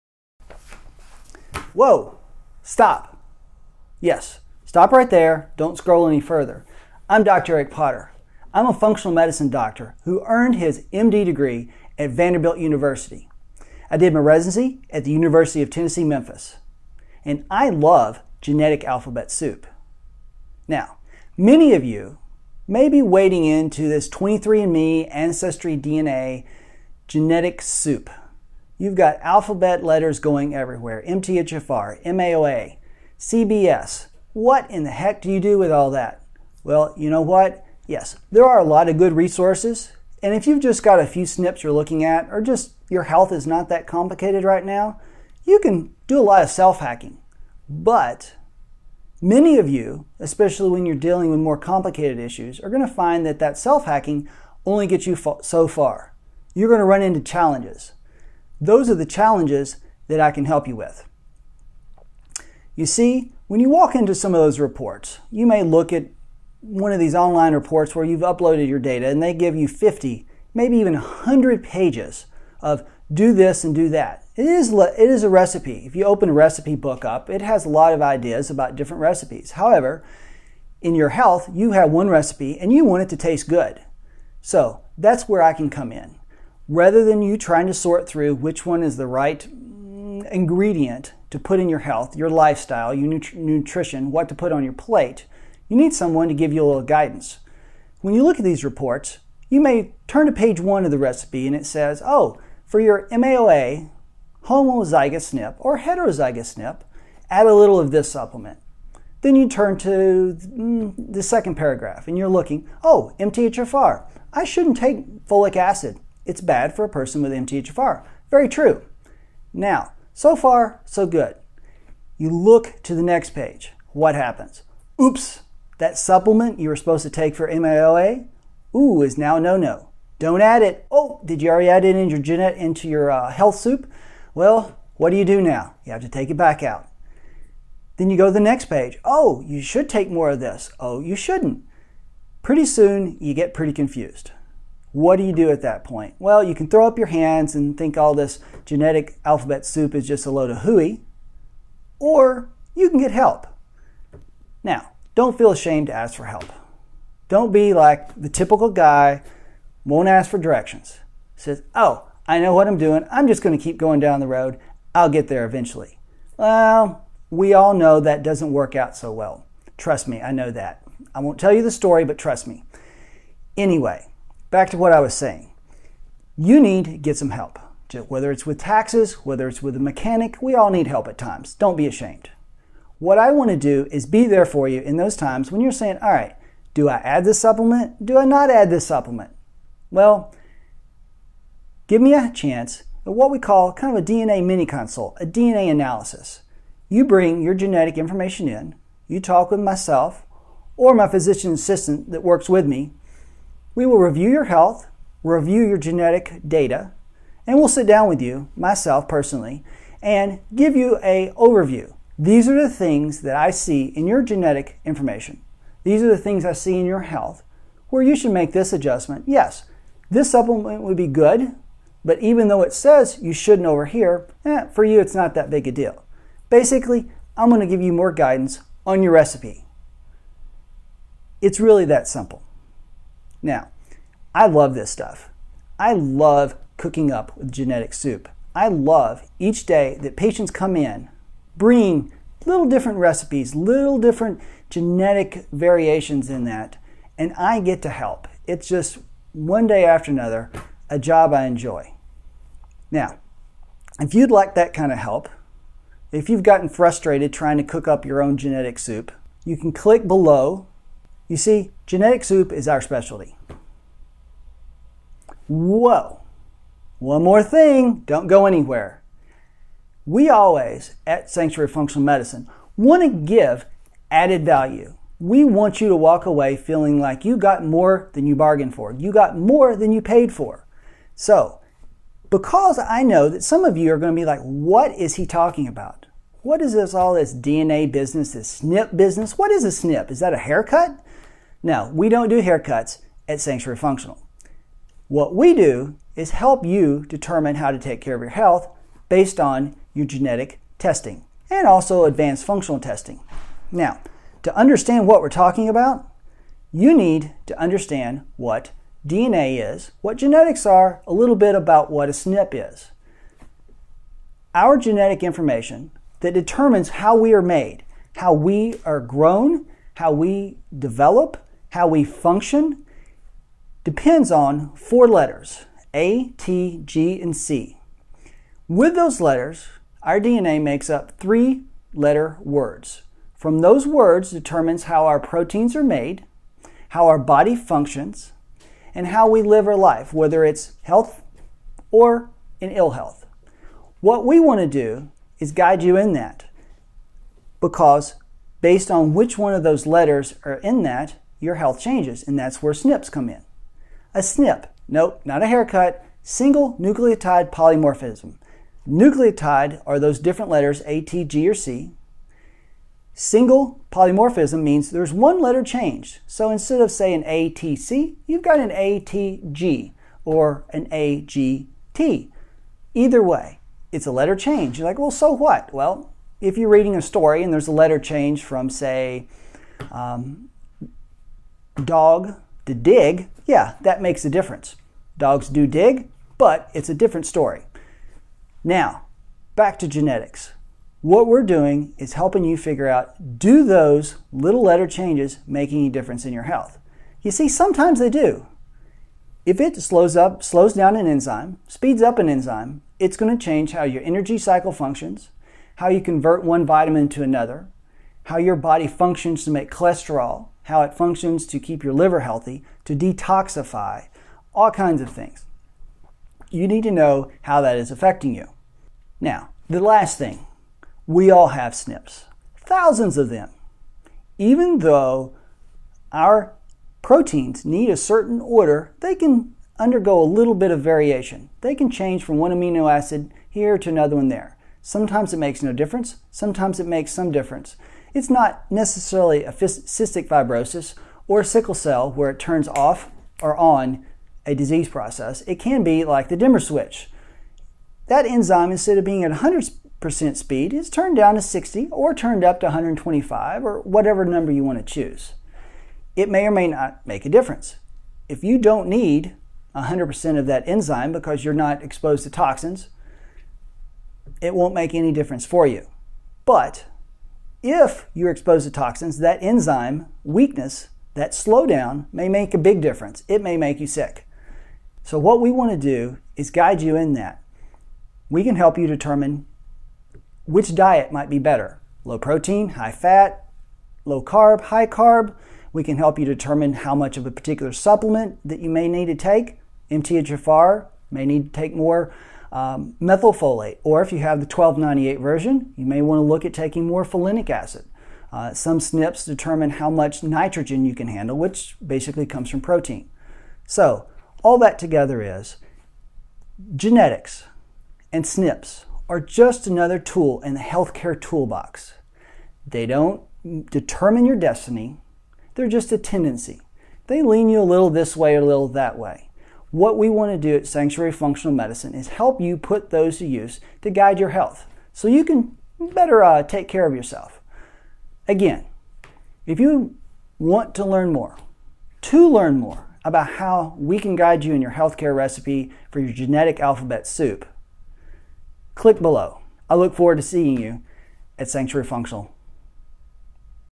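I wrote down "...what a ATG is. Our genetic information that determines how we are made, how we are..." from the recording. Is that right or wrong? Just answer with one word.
wrong.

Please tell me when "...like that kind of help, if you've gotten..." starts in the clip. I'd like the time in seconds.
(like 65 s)
254 s.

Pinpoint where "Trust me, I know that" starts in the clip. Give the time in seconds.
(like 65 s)
169 s.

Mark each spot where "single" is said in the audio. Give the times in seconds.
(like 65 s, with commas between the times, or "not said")
356 s, 363 s.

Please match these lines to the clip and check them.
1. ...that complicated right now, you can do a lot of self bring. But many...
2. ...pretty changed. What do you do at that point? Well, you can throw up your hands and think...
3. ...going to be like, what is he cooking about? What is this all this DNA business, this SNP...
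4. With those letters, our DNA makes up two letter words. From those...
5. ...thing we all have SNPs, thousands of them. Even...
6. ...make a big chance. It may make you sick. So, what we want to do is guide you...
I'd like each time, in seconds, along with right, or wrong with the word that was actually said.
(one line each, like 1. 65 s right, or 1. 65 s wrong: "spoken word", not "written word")
1. 43 s wrong: "hacking", not "bring"
2. 143 s wrong: "confused", not "changed"
3. 283 s wrong: "talking", not "cooking"
4. 328 s wrong: "three", not "two"
5. 420 s right
6. 472 s wrong: "difference", not "chance".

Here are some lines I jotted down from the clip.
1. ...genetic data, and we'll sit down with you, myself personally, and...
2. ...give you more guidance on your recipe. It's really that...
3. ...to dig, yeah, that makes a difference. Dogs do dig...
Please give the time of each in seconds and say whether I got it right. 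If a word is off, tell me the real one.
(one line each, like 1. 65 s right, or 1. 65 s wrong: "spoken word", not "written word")
1. 205 s right
2. 227 s right
3. 382 s right.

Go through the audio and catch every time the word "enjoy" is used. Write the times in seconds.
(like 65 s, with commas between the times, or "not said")
251 s.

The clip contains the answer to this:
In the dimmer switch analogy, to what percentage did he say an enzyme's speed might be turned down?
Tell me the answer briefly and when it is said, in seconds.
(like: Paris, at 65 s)
60, at 451 s.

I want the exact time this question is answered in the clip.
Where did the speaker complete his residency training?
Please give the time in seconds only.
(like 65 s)
15 s.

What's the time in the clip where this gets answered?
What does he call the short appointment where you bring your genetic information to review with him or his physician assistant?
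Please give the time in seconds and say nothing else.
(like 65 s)
194 s.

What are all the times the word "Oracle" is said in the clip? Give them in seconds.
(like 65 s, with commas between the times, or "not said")
not said.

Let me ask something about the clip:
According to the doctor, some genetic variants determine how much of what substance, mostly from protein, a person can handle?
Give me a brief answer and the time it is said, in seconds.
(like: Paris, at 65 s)
nitrogen, at 500 s.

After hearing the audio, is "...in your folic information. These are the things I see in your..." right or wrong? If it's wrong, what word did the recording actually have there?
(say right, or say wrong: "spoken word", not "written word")
wrong: "genetic", not "folic".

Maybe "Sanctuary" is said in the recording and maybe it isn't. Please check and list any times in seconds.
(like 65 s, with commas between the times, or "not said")
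271 s, 293 s, 520 s, 541 s.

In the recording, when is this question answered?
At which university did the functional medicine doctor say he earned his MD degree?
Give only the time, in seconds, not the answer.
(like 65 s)
12 s.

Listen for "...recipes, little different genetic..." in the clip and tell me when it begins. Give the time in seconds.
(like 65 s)
242 s.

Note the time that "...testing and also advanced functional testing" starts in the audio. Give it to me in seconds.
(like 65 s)
300 s.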